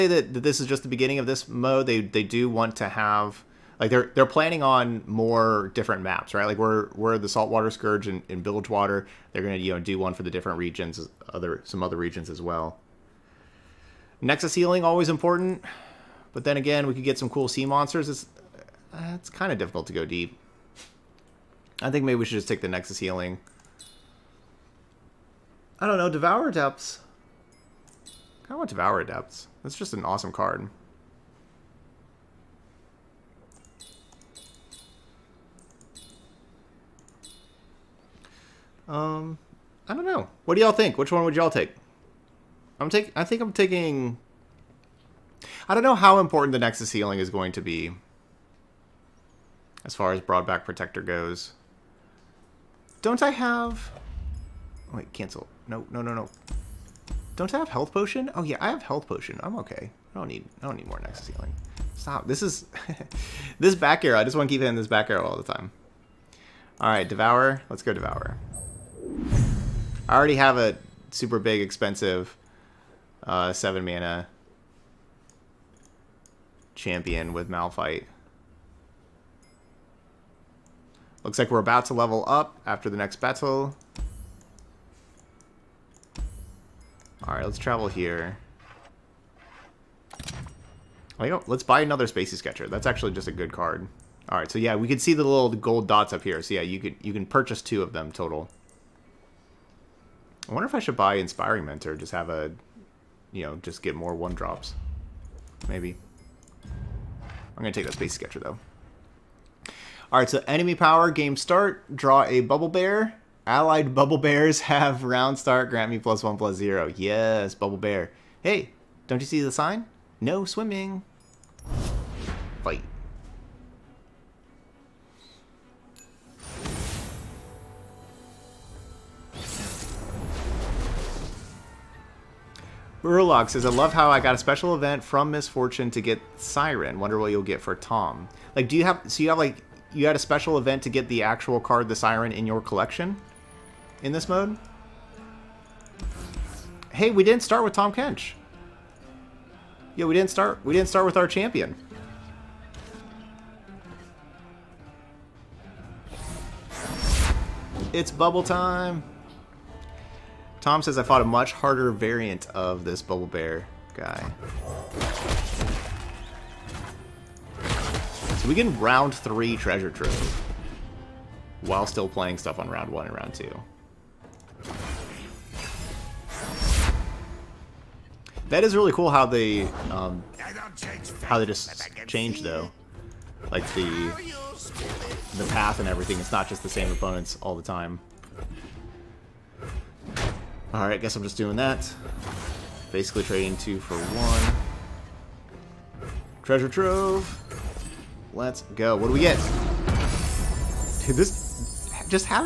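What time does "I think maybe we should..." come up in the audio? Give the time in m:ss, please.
0:21.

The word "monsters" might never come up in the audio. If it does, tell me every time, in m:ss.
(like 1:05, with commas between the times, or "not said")
0:17.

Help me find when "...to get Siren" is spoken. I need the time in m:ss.
2:15.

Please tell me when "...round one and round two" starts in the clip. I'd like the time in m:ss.
2:52.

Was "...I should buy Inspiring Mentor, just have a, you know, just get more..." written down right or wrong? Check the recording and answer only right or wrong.
right.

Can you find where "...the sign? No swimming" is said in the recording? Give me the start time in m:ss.
1:59.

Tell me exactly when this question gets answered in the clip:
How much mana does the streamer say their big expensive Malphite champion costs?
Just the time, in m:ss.
1:13.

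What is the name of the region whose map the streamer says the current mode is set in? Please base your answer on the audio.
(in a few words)
Bilgewater.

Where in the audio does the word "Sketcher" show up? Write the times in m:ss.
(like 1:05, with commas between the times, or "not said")
1:32, 1:48.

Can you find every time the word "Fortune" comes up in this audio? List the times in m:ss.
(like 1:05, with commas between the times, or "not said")
2:15.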